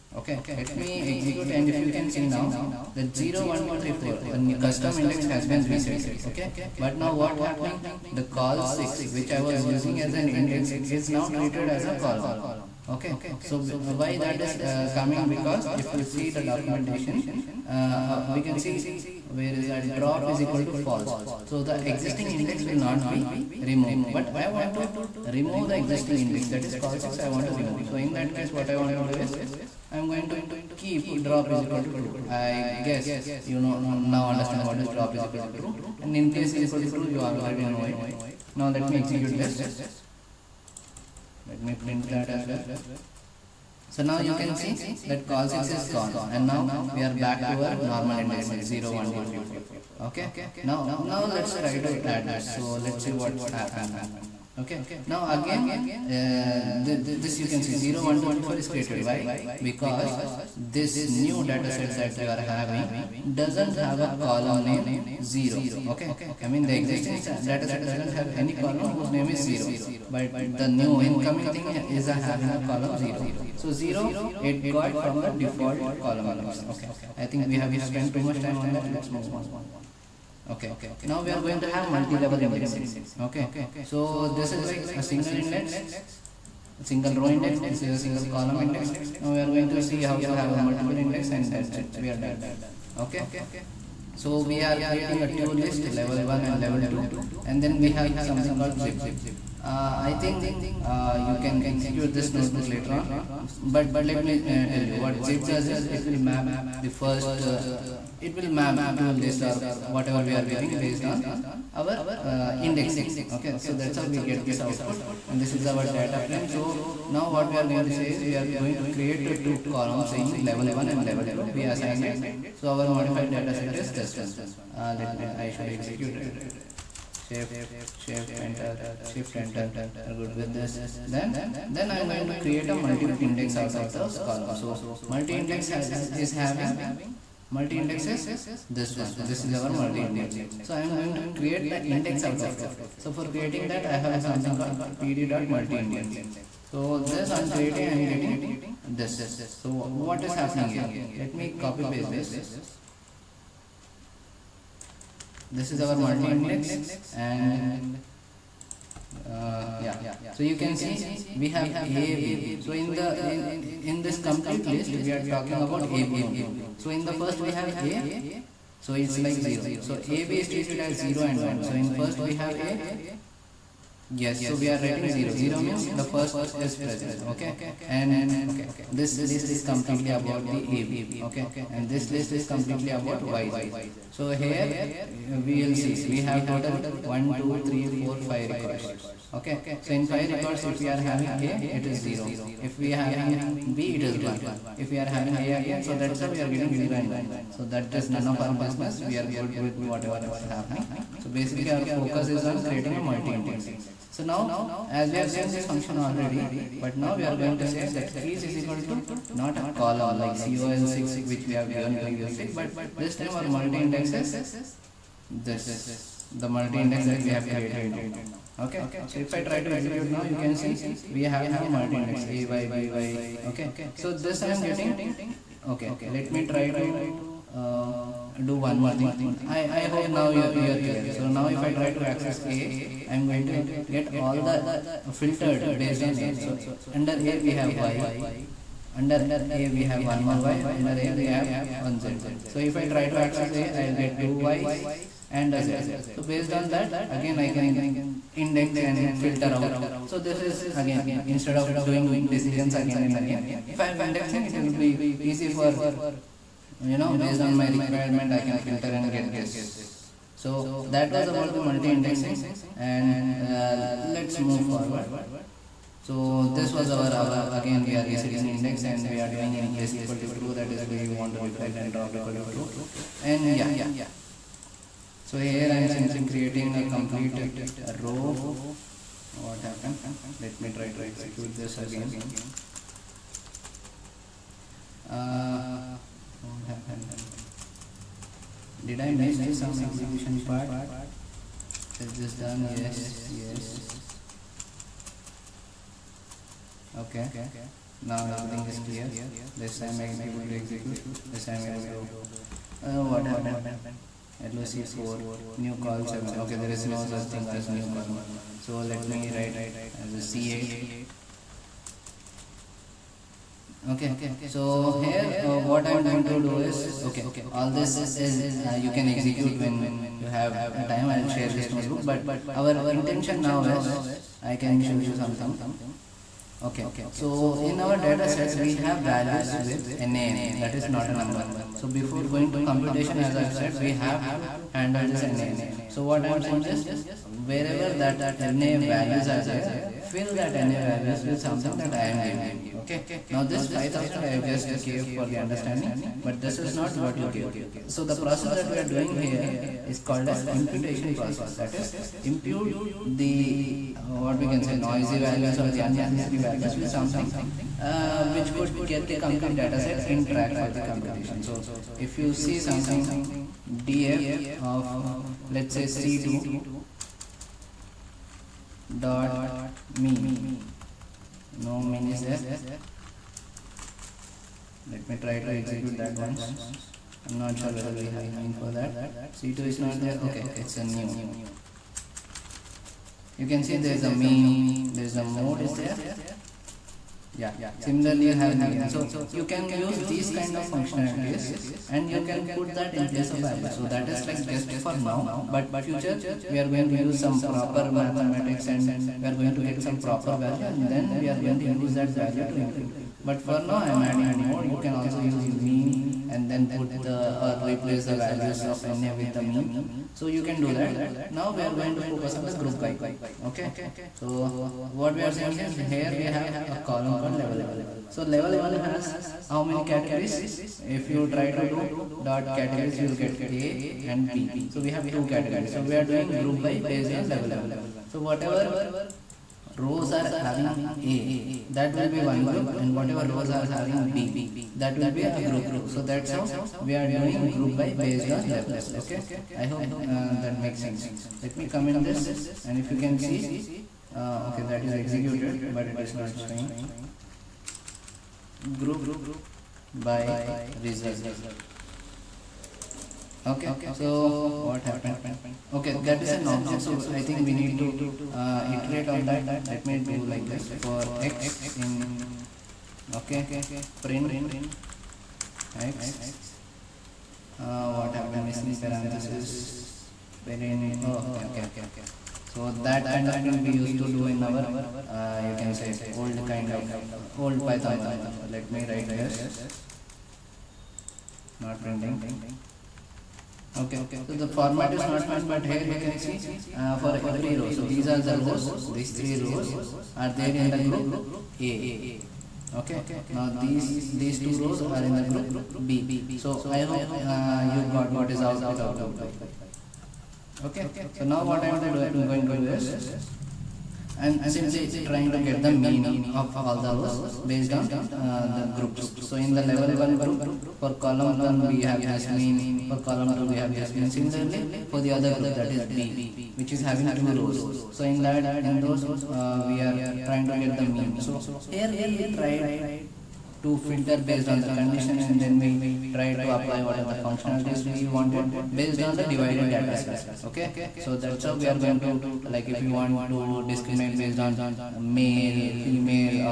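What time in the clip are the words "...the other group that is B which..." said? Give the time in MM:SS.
08:35.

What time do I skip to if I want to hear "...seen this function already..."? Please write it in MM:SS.
03:25.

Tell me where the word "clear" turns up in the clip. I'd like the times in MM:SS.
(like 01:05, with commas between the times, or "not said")
03:50, 04:58.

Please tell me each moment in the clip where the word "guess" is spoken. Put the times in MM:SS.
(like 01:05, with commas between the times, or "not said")
00:32.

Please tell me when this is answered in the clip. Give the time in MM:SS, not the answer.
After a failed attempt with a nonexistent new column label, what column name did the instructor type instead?
05:10.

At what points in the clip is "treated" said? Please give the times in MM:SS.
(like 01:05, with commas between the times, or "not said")
00:11, 02:50.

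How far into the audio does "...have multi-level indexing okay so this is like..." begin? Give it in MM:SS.
01:21.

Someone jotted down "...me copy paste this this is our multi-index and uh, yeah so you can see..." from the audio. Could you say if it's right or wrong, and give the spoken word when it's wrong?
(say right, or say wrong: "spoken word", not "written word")
right.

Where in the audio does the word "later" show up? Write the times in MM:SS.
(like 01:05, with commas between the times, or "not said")
01:42.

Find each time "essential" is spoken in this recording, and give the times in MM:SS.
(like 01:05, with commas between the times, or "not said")
not said.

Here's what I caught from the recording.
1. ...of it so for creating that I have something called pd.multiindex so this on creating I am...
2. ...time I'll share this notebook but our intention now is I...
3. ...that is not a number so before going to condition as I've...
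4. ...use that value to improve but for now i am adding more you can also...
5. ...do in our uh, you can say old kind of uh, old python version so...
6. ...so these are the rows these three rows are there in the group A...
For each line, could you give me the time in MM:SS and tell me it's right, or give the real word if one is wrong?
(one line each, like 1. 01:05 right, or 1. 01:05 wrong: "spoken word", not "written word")
1. 02:22 right
2. 05:20 right
3. 05:30 wrong: "computation", not "condition"
4. 06:41 right
5. 07:54 right
6. 08:07 right.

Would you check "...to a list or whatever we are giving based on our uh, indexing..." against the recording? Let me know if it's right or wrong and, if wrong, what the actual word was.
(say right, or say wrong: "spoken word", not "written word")
right.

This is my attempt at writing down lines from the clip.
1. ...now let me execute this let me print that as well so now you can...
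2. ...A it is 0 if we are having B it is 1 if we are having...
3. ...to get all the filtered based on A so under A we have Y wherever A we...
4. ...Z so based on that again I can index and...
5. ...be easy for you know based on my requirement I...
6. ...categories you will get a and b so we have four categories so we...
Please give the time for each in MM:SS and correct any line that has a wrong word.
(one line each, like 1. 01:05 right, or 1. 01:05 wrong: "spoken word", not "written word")
1. 00:38 right
2. 03:11 right
3. 03:53 wrong: "under", not "wherever"
4. 04:05 right
5. 04:14 right
6. 07:02 wrong: "two", not "four".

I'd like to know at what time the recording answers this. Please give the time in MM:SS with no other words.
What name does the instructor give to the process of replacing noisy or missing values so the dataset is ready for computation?
05:50.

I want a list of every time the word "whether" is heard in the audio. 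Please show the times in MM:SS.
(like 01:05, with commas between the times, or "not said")
06:17.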